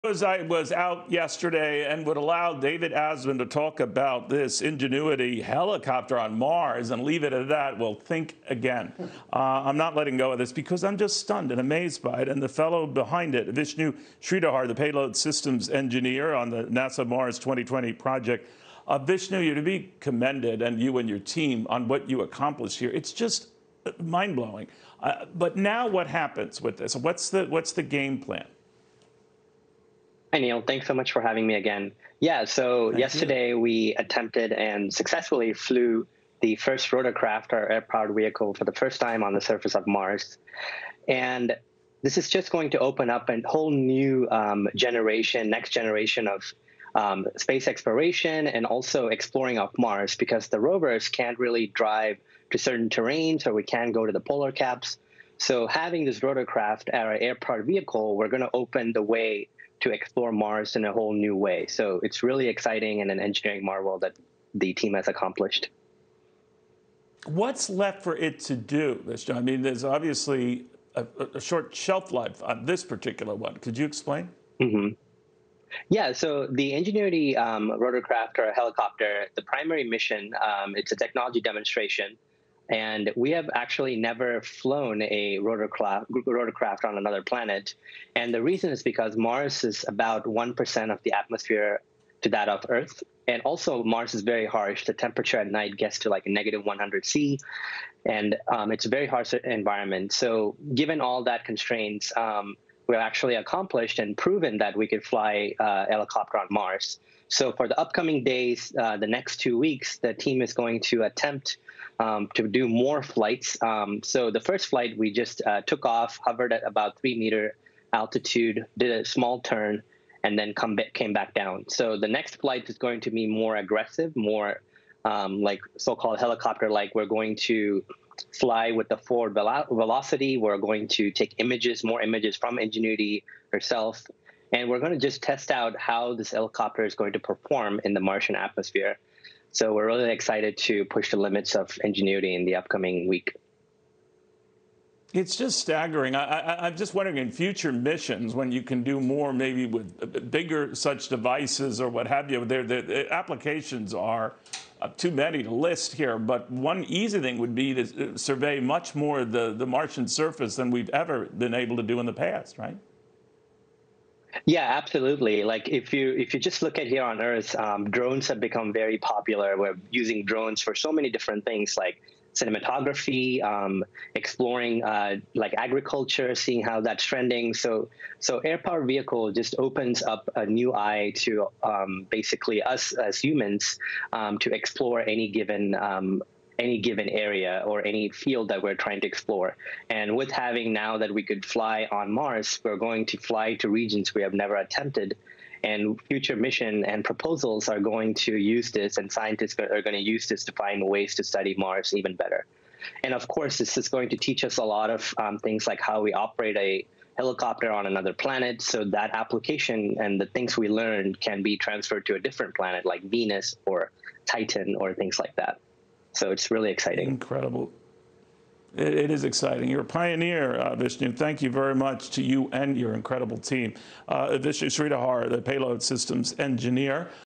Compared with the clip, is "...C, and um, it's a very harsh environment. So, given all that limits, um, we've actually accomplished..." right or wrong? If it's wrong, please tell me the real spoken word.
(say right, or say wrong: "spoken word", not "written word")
wrong: "constraints", not "limits".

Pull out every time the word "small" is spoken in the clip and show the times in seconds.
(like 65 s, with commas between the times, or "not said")
119 s.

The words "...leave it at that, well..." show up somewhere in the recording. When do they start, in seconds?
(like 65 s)
7 s.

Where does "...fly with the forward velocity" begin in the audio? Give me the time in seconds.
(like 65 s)
128 s.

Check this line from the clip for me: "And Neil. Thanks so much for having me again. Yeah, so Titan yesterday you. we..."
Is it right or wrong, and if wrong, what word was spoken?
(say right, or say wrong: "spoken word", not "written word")
wrong: "Thank", not "Titan".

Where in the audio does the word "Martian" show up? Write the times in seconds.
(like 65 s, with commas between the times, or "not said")
137 s, 159 s.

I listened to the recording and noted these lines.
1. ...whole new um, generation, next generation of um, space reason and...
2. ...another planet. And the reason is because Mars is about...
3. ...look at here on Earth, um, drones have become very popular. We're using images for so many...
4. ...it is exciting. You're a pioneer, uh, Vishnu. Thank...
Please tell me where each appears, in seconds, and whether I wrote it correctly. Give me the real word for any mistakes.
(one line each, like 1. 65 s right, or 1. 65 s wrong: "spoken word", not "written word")
1. 43 s wrong: "exploration", not "reason"
2. 86 s right
3. 166 s wrong: "drones", not "images"
4. 218 s right.